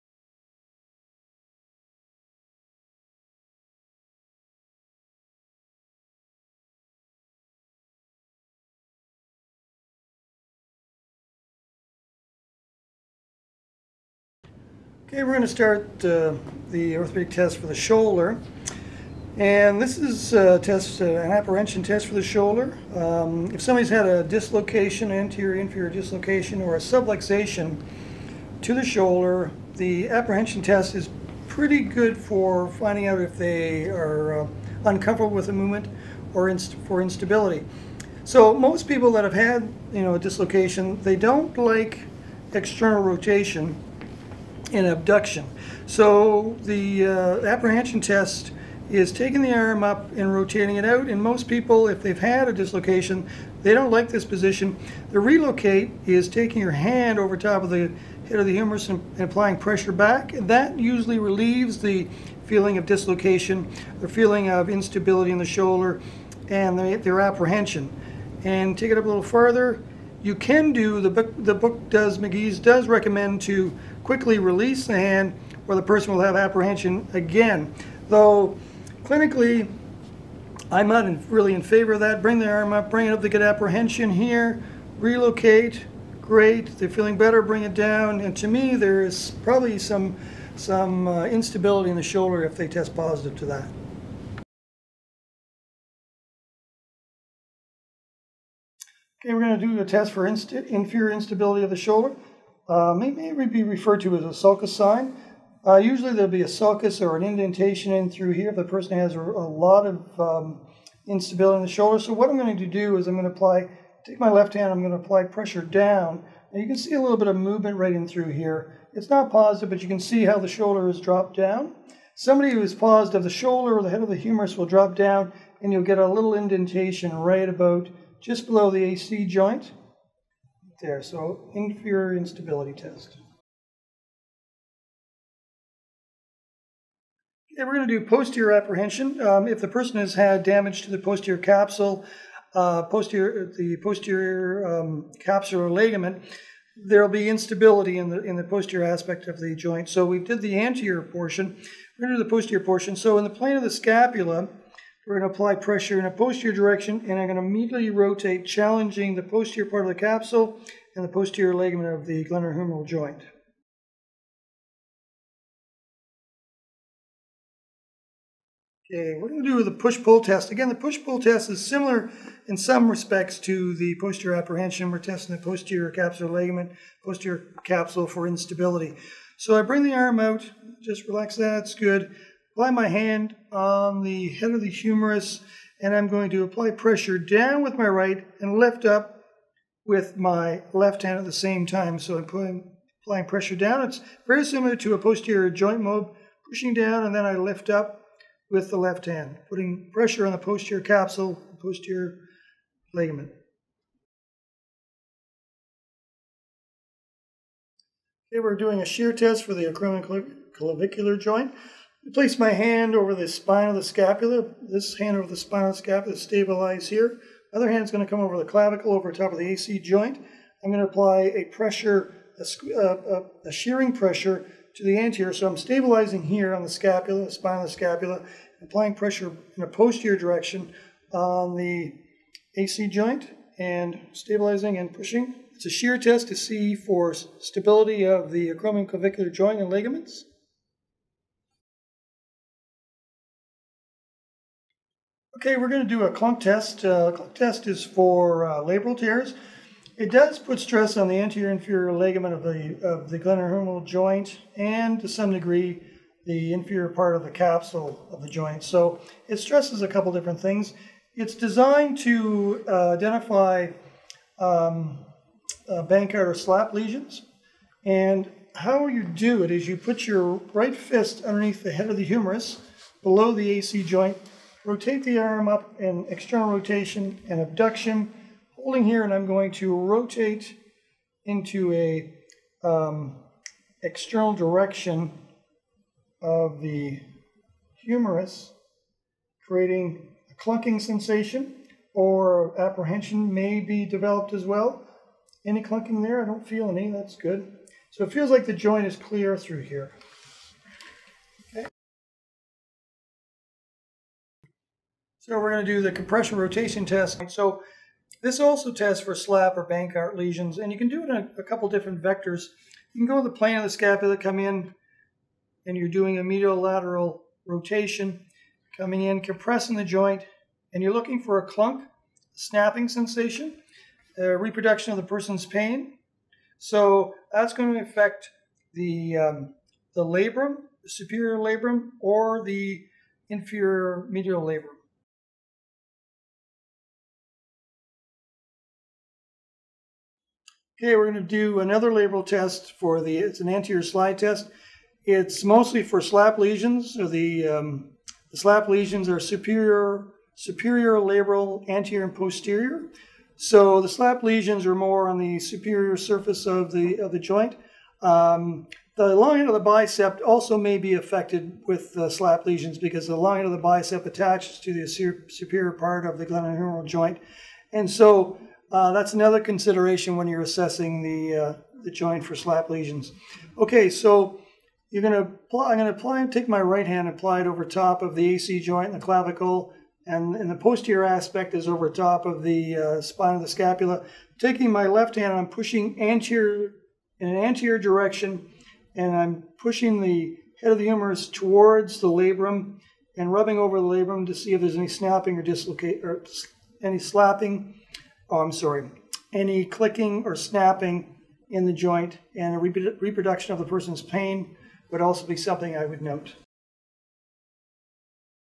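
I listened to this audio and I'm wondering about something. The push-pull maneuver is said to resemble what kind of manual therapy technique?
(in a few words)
posterior joint mob.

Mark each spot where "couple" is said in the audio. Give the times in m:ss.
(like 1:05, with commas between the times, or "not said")
4:19, 5:11.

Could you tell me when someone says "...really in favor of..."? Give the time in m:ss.
1:21.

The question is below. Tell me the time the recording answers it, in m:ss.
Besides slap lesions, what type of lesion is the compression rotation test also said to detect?
5:09.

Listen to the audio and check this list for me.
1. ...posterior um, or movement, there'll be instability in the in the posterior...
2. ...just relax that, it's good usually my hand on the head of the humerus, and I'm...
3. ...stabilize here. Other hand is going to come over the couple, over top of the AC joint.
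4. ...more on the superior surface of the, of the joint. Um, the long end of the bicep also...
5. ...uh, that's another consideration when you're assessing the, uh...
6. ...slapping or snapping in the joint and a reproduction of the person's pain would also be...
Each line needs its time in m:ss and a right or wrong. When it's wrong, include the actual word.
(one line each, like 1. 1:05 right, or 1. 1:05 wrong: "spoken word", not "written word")
1. 2:23 wrong: "ligament", not "movement"
2. 3:00 wrong: "apply", not "usually"
3. 3:36 wrong: "clavicle", not "couple"
4. 5:54 right
5. 6:08 right
6. 6:39 wrong: "clicking", not "slapping".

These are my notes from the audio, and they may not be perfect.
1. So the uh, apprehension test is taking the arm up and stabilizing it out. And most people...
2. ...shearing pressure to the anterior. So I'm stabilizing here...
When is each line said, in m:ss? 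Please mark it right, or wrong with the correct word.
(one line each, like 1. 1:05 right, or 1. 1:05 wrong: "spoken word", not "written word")
1. 0:45 wrong: "rotating", not "stabilizing"
2. 3:43 right.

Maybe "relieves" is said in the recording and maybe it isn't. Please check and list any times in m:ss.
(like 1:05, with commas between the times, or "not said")
1:01.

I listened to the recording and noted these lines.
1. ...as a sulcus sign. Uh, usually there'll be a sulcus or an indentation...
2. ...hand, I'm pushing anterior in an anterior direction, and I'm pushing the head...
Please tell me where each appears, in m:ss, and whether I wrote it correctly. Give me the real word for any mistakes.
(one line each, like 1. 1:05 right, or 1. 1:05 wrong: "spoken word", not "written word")
1. 1:44 right
2. 6:25 right.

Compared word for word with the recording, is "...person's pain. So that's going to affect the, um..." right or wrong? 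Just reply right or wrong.
right.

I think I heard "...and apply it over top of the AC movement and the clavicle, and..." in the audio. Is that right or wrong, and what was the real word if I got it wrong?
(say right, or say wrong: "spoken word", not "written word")
wrong: "joint", not "movement".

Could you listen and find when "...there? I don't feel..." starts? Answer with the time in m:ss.
4:56.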